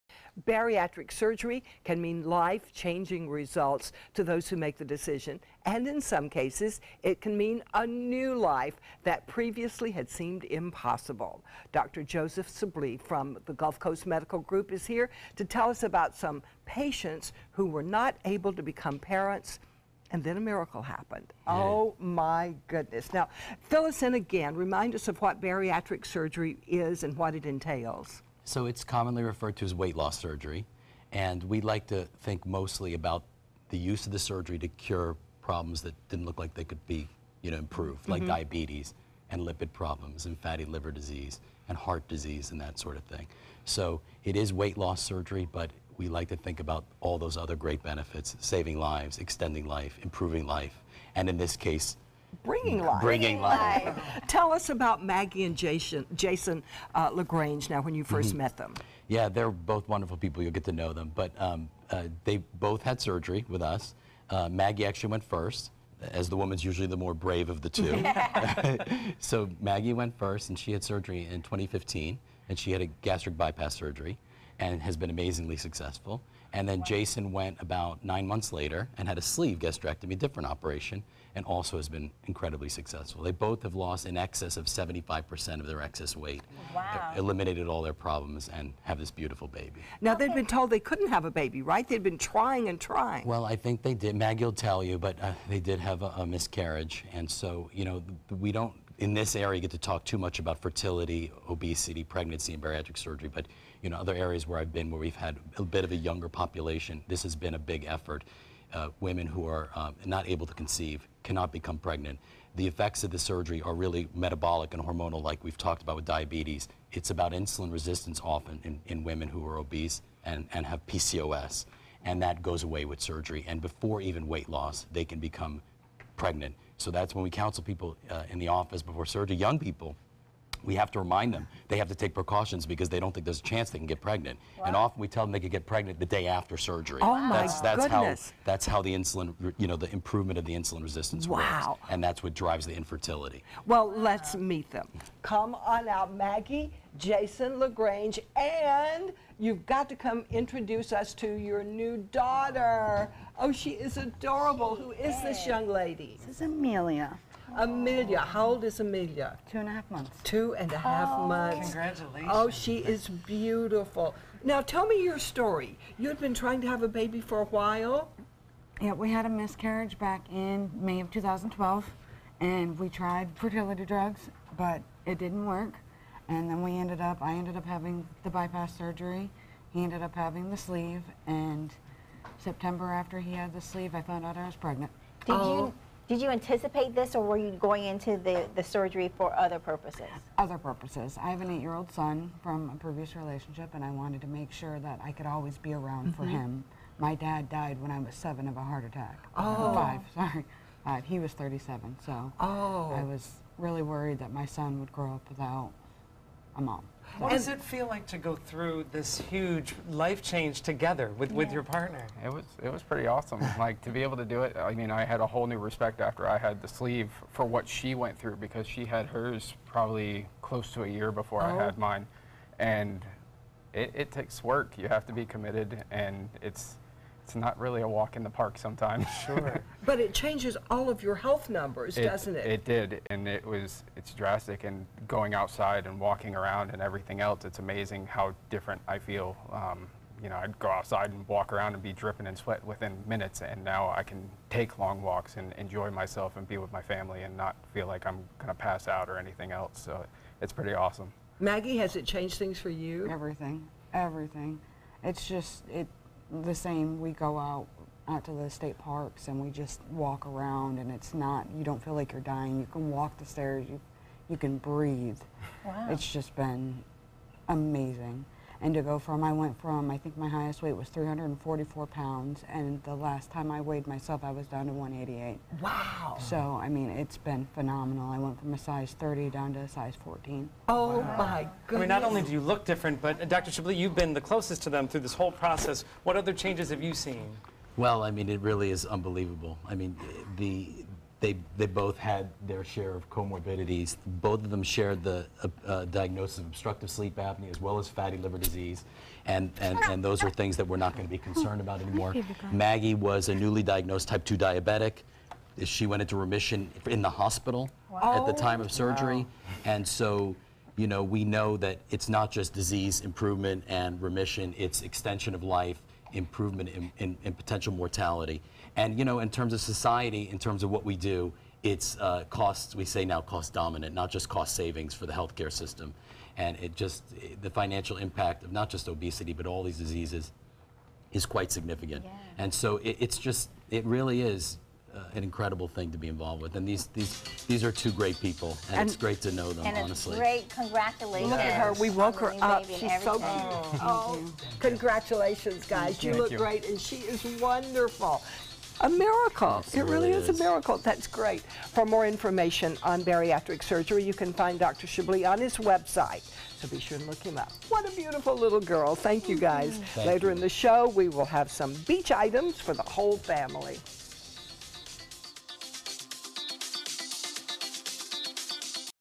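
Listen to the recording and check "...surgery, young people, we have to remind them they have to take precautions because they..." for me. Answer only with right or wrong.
right.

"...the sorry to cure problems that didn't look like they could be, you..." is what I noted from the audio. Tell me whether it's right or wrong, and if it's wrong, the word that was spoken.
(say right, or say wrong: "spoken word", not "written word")
wrong: "surgery", not "sorry".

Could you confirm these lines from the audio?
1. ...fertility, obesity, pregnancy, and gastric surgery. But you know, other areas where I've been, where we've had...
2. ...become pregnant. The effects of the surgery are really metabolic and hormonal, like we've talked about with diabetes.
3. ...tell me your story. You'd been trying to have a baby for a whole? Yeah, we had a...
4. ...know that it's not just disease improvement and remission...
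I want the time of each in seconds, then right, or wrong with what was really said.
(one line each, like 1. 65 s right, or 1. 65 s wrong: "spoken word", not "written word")
1. 100 s wrong: "bariatric", not "gastric"
2. 111 s right
3. 164 s wrong: "while", not "whole"
4. 311 s right.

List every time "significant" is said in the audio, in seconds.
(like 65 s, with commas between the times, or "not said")
331 s.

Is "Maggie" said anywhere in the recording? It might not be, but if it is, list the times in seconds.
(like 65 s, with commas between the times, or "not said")
55 s, 64 s, 69 s, 94 s, 146 s, 251 s, 302 s.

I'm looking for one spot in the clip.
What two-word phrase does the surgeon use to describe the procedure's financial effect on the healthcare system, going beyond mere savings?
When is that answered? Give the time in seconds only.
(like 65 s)
323 s.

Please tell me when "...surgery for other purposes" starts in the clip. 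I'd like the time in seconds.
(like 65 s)
188 s.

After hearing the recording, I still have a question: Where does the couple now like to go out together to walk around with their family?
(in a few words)
state parks.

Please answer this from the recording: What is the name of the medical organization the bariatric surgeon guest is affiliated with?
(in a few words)
Gulf Coast Medical Group.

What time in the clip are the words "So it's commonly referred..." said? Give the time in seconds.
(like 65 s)
28 s.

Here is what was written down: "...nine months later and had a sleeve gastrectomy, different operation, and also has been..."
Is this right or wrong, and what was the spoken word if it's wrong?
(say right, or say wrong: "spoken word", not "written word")
right.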